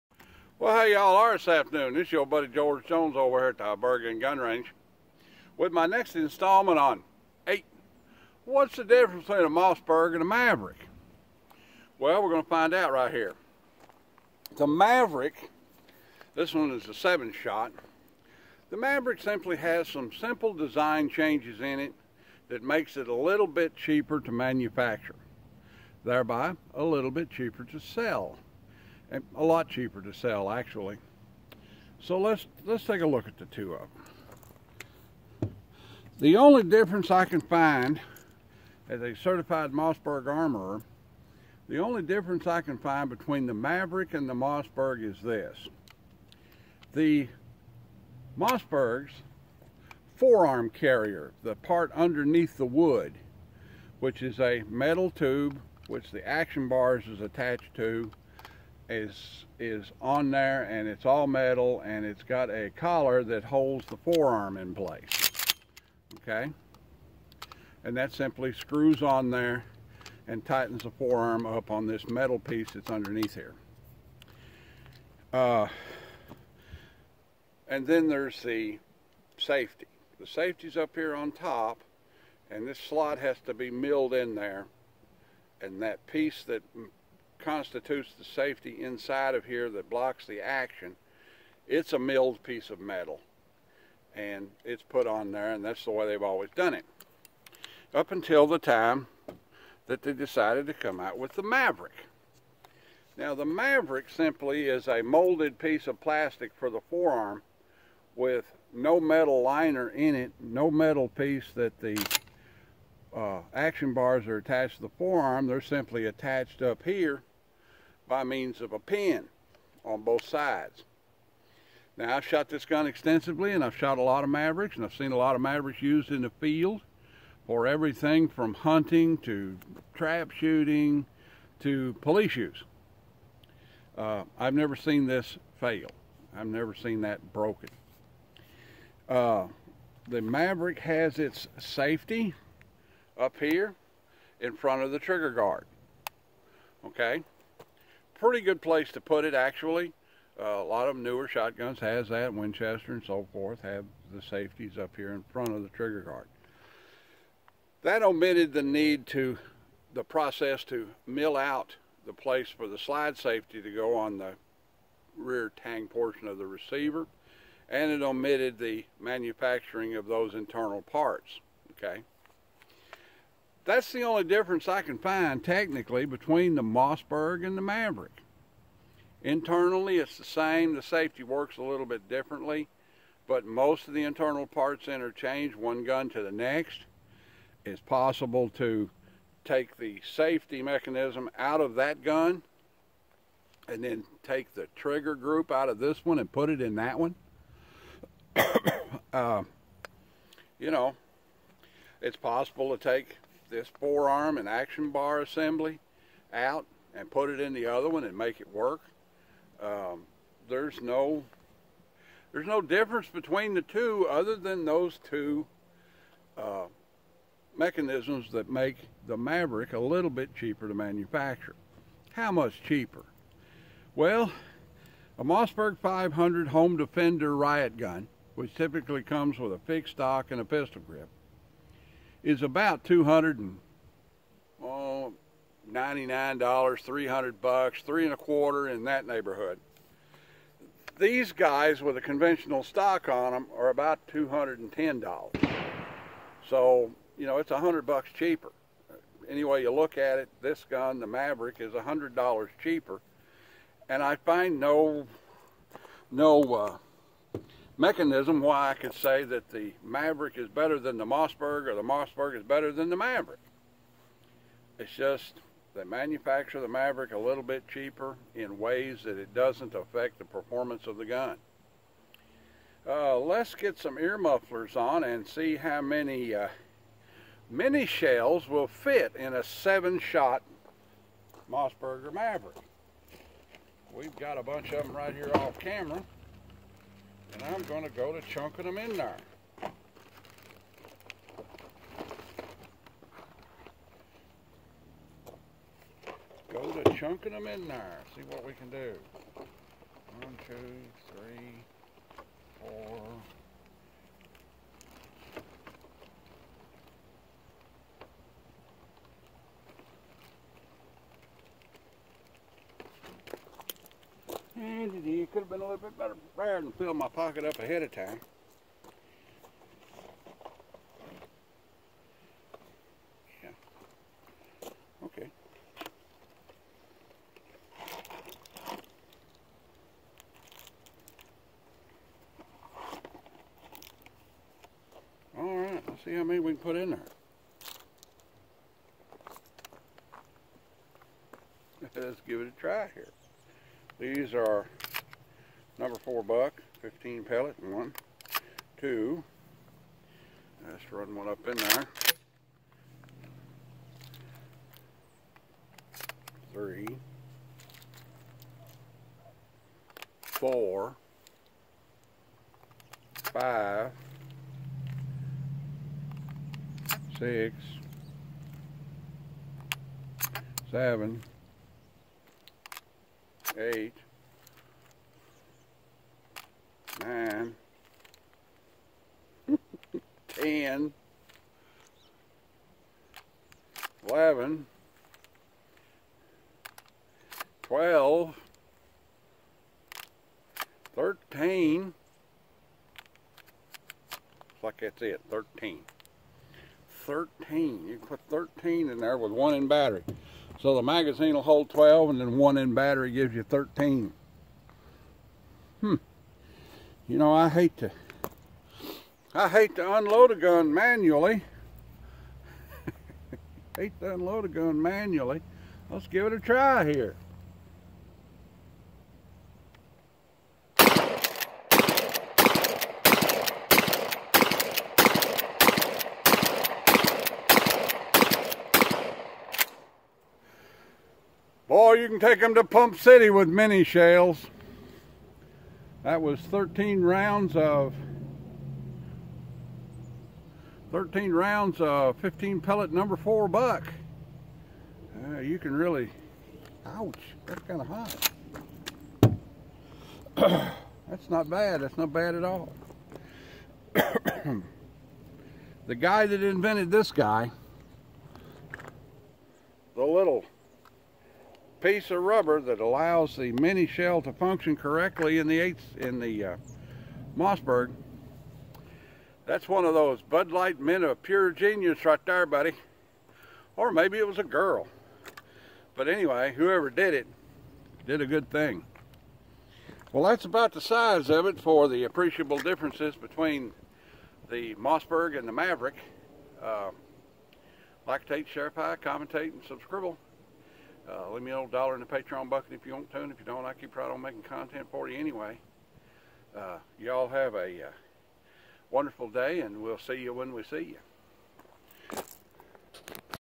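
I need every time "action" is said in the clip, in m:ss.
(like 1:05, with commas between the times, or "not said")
0:56, 1:30, 1:53, 3:24.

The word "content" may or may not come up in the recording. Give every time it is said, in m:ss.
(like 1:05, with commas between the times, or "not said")
8:14.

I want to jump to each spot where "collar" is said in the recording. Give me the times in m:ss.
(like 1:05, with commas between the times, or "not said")
1:02.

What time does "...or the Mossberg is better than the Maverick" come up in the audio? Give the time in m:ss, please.
4:21.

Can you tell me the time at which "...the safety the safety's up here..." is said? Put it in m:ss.
1:18.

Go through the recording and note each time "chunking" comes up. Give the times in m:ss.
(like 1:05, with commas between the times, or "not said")
4:48, 4:56.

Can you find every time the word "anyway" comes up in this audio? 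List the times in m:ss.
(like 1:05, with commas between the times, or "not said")
7:56, 8:15.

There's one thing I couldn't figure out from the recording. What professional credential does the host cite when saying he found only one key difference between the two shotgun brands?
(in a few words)
certified Mossberg armorer.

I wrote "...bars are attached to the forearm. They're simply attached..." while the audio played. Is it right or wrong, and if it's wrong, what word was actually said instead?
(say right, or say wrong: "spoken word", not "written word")
right.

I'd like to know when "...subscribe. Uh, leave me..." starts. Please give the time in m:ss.
8:09.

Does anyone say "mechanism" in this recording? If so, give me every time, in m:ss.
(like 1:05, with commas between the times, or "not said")
3:10, 3:37, 4:17.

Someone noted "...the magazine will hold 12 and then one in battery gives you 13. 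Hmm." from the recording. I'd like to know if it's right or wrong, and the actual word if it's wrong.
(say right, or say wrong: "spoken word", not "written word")
right.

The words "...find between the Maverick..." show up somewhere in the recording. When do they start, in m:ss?
0:42.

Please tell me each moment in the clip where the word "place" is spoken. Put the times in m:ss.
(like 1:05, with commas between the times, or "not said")
1:04, 2:28, 2:42.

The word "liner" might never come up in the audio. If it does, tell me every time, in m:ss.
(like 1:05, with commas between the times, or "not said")
1:49.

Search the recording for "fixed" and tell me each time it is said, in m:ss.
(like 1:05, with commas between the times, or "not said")
3:49.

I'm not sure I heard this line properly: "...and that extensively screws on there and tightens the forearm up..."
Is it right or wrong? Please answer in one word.
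wrong.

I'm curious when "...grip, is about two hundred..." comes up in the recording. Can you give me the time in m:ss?
3:50.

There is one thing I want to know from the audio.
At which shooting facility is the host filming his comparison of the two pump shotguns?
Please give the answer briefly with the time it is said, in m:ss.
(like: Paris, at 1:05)
Bergen Gun Range, at 0:03.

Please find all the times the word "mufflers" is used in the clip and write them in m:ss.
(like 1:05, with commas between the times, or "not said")
4:34.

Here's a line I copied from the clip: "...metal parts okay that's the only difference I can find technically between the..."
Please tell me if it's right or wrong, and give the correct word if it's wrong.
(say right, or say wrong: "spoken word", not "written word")
wrong: "internal", not "metal".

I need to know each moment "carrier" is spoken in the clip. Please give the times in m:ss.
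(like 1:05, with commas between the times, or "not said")
0:50.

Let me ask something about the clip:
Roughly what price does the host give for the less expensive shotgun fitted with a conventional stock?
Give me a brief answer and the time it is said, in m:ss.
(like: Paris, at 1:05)
$210, at 4:04.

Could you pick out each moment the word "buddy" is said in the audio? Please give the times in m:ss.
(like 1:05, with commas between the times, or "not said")
0:02, 7:52.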